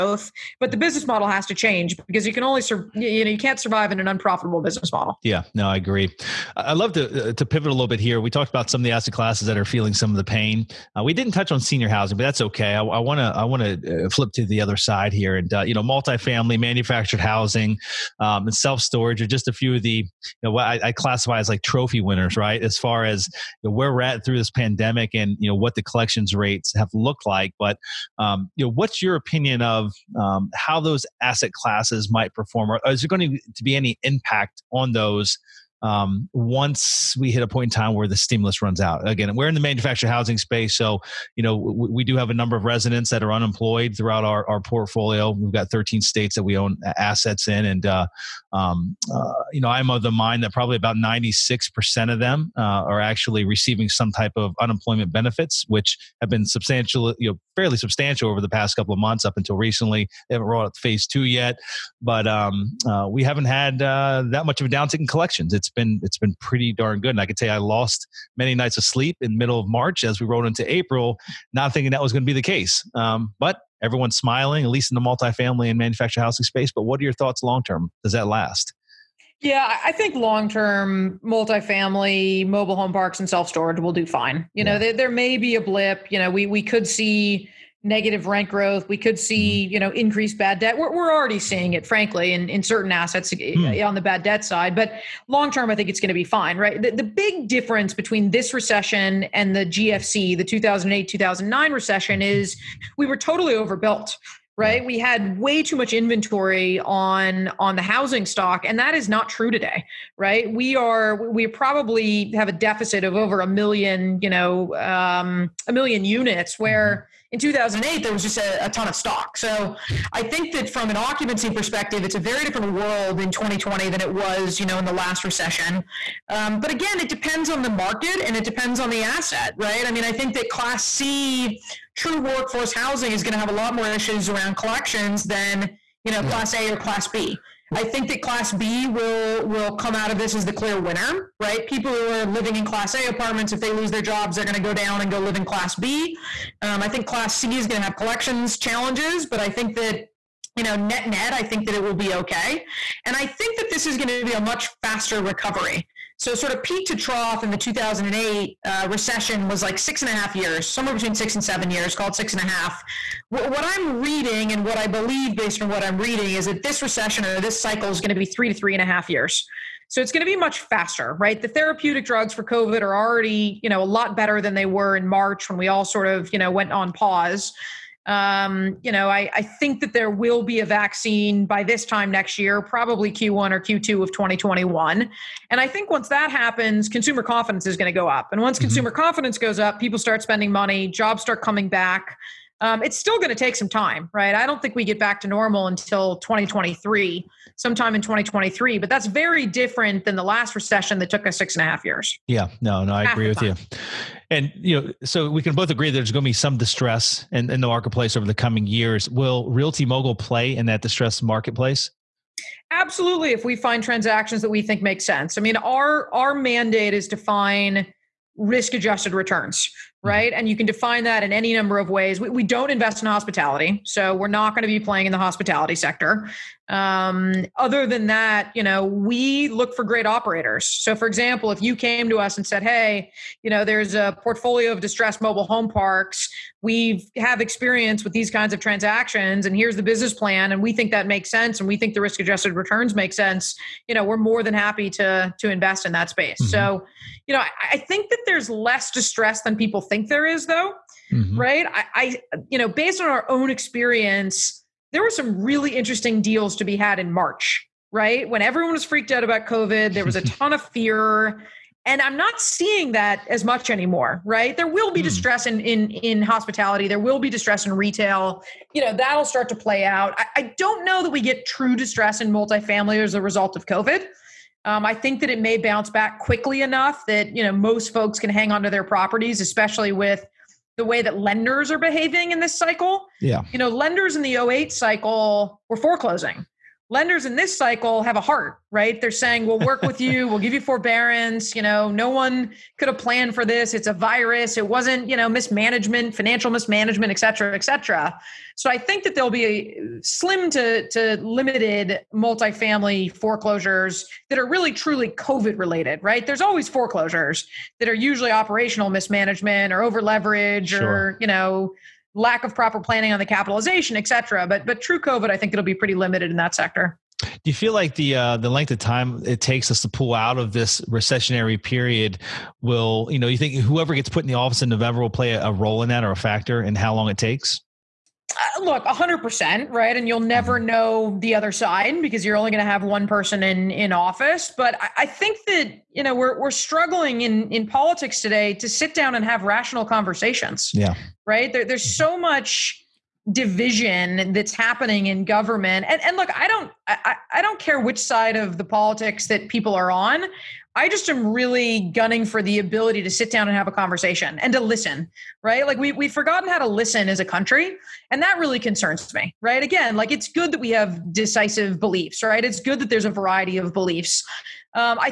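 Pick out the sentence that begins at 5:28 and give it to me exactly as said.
Uh, look 100% right and you'll never mm-hmm.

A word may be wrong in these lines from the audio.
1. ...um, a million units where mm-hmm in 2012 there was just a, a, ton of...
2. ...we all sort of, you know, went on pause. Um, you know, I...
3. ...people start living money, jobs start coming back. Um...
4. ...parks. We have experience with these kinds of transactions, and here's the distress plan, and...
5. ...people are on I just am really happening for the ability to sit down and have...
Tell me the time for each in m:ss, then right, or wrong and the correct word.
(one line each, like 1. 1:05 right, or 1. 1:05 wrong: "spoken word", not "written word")
1. 1:54 wrong: "2008", not "2012"
2. 2:55 right
3. 3:09 wrong: "spending", not "living"
4. 3:55 wrong: "business", not "distress"
5. 5:49 wrong: "gunning", not "happening".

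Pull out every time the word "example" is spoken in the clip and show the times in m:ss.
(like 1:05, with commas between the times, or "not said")
3:51.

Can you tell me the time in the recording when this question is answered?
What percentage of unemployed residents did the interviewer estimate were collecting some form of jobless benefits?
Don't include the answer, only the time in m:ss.
0:50.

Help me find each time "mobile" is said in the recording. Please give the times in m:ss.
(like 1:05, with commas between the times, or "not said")
1:22, 3:55.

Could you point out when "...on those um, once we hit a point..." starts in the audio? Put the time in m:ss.
0:34.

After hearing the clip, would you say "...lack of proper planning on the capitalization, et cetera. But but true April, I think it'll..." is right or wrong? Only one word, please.
wrong.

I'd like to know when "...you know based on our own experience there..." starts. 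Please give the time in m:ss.
4:12.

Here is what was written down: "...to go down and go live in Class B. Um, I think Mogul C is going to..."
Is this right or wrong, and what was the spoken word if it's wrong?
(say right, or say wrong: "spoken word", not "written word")
wrong: "Class", not "Mogul".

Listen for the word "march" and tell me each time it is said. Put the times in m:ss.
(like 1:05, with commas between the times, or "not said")
1:09, 2:55, 4:17.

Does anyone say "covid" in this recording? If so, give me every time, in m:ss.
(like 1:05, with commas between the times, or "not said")
2:52, 4:19, 4:33, 5:05, 5:14.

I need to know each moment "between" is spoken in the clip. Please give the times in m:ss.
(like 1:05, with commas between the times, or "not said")
1:37, 2:40.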